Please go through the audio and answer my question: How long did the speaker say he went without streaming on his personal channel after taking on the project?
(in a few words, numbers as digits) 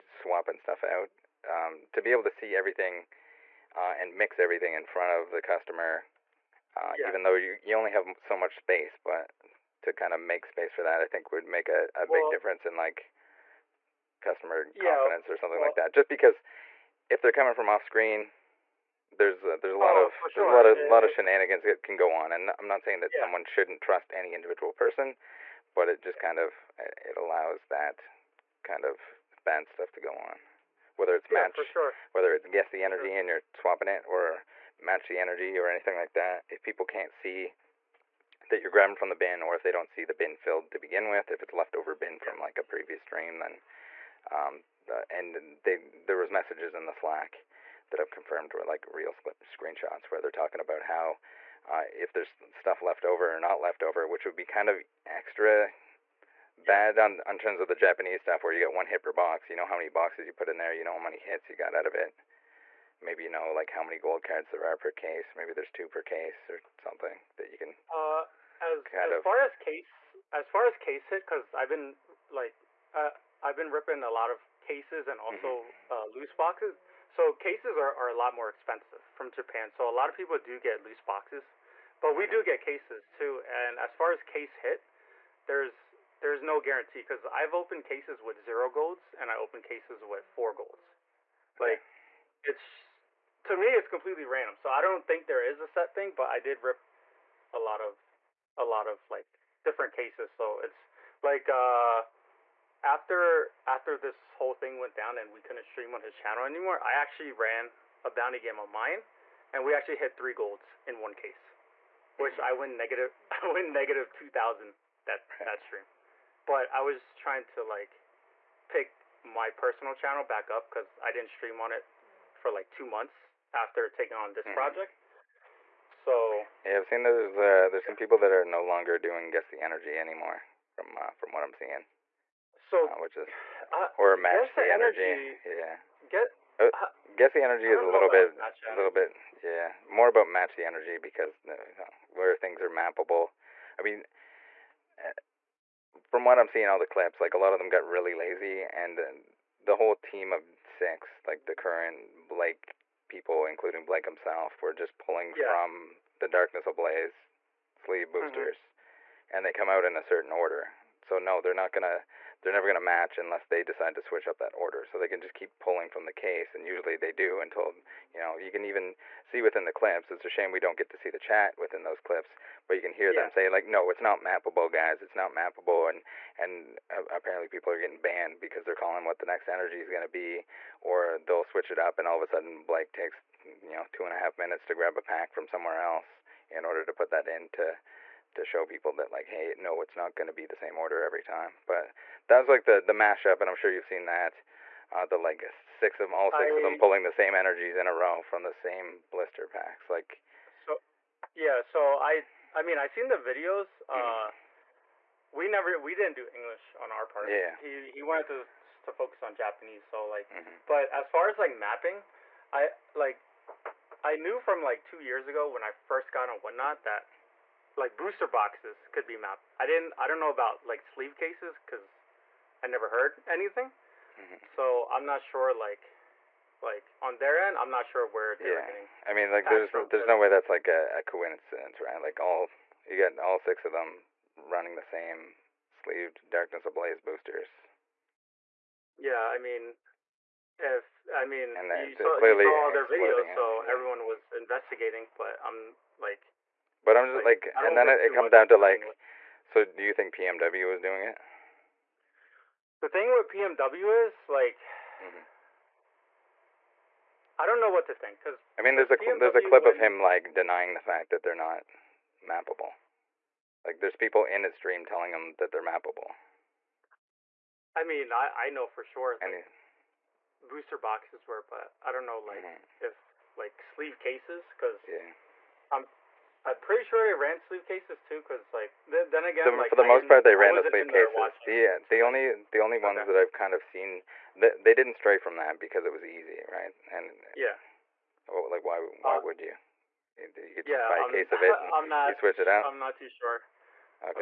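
two months.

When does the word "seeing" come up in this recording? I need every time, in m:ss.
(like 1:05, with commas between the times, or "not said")
2:11, 2:26.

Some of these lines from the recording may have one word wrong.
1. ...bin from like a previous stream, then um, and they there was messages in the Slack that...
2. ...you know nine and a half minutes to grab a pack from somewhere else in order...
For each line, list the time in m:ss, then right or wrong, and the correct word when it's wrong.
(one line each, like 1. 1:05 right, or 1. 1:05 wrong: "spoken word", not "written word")
1. 0:41 right
2. 3:03 wrong: "two", not "nine".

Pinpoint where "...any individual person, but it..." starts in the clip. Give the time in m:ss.
0:24.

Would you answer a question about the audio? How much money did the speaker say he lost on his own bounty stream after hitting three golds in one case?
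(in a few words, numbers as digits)
2000.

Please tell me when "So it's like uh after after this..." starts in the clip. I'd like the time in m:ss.
1:40.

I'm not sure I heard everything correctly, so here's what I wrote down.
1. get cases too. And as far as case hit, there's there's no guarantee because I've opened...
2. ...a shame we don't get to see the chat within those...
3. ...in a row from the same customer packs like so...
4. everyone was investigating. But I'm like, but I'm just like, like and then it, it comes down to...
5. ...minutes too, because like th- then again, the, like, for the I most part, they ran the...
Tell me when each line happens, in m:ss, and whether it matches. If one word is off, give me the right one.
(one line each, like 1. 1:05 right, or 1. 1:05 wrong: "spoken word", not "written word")
1. 1:22 right
2. 2:50 right
3. 3:17 wrong: "blister", not "customer"
4. 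4:03 right
5. 4:37 wrong: "cases", not "minutes".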